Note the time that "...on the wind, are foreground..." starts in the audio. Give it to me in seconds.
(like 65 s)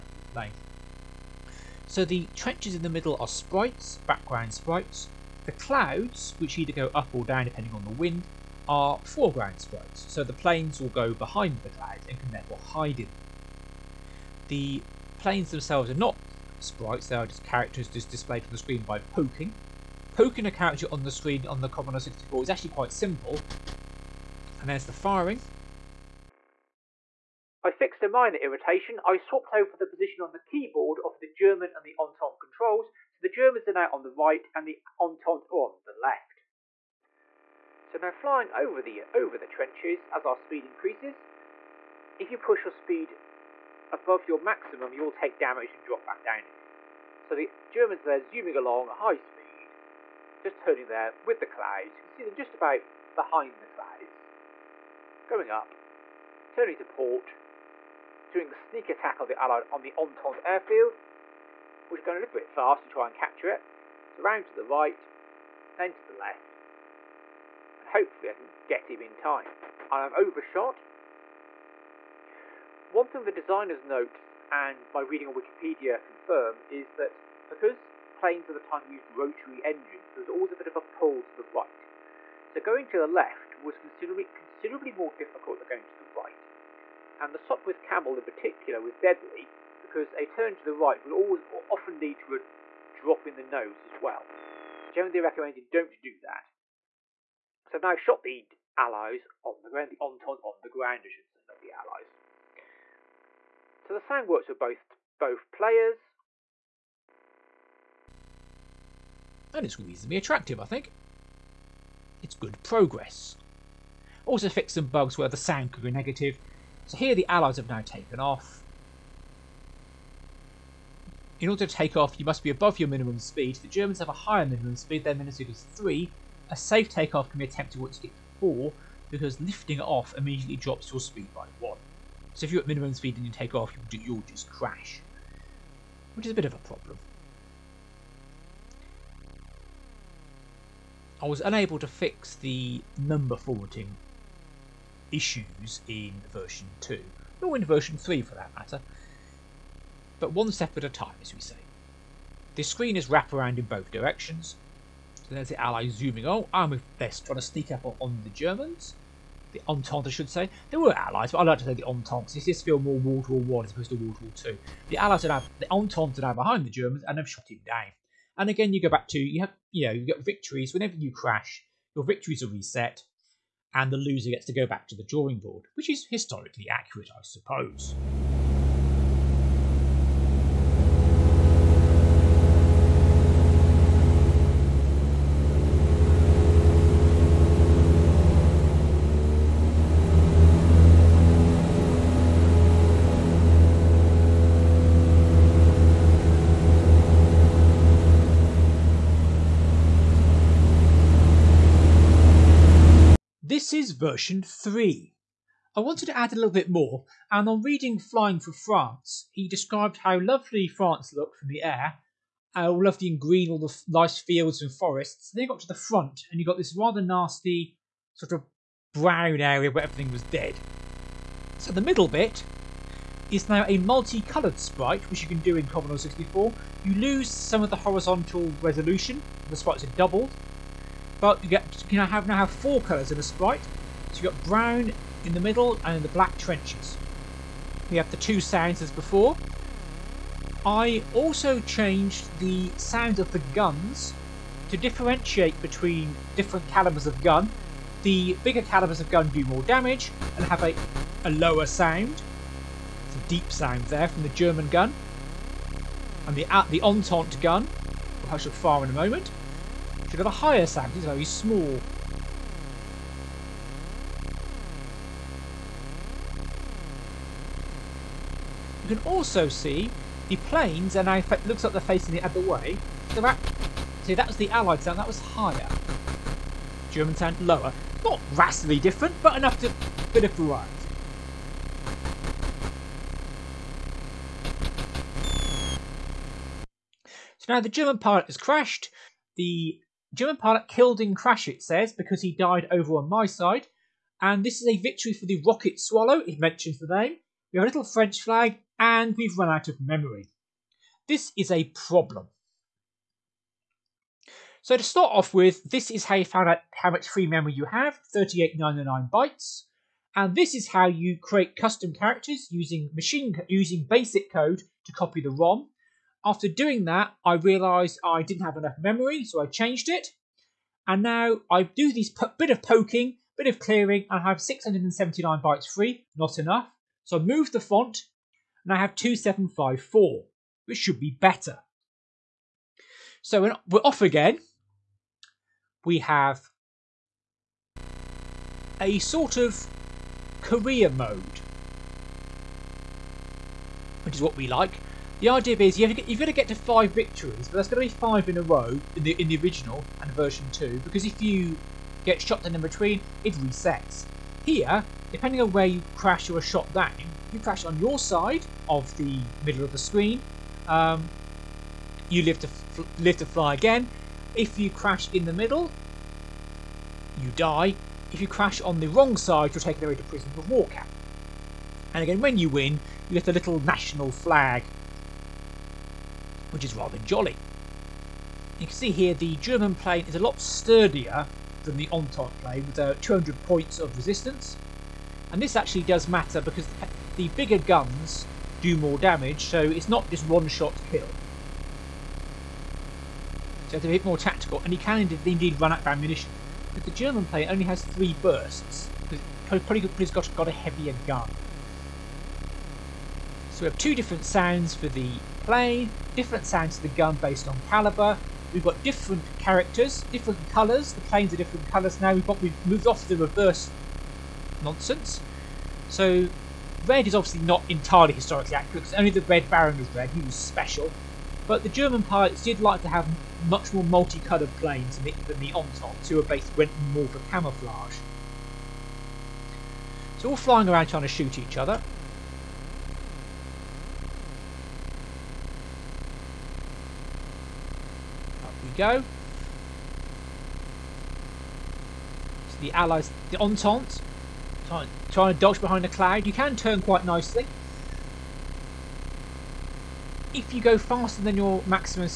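7 s.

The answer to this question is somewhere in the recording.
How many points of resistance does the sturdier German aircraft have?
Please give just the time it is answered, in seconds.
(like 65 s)
383 s.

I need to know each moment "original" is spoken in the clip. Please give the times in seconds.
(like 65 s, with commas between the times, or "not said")
349 s.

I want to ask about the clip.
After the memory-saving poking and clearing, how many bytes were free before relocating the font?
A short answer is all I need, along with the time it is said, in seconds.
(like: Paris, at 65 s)
679, at 324 s.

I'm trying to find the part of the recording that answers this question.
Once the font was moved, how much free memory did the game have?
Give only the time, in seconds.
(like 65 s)
328 s.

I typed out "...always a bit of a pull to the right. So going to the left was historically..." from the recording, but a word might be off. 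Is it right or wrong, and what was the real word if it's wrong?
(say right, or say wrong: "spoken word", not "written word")
wrong: "considerably", not "historically".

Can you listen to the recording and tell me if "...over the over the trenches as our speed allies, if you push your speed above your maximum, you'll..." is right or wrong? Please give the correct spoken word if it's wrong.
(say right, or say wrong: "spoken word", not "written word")
wrong: "increases", not "allies".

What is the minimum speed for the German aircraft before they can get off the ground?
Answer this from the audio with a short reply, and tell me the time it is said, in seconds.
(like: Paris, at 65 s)
3, at 125 s.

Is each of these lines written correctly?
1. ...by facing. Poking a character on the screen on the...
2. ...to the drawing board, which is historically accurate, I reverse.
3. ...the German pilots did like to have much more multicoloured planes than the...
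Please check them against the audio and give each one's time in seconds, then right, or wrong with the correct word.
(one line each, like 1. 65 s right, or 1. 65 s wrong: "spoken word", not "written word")
1. 18 s wrong: "poking", not "facing"
2. 174 s wrong: "suppose", not "reverse"
3. 421 s right.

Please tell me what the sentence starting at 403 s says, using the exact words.
So we have two different sounds for the plane different sounds to the gun based on caliber.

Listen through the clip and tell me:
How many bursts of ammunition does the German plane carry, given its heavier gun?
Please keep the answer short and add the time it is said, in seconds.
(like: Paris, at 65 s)
3, at 397 s.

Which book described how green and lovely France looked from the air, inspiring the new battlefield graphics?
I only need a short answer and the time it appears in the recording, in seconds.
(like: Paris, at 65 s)
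Flying for France, at 207 s.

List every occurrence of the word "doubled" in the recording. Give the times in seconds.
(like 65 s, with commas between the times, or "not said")
229 s.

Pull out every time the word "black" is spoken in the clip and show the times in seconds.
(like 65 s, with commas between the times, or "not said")
236 s.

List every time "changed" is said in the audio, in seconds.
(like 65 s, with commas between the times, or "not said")
241 s, 319 s.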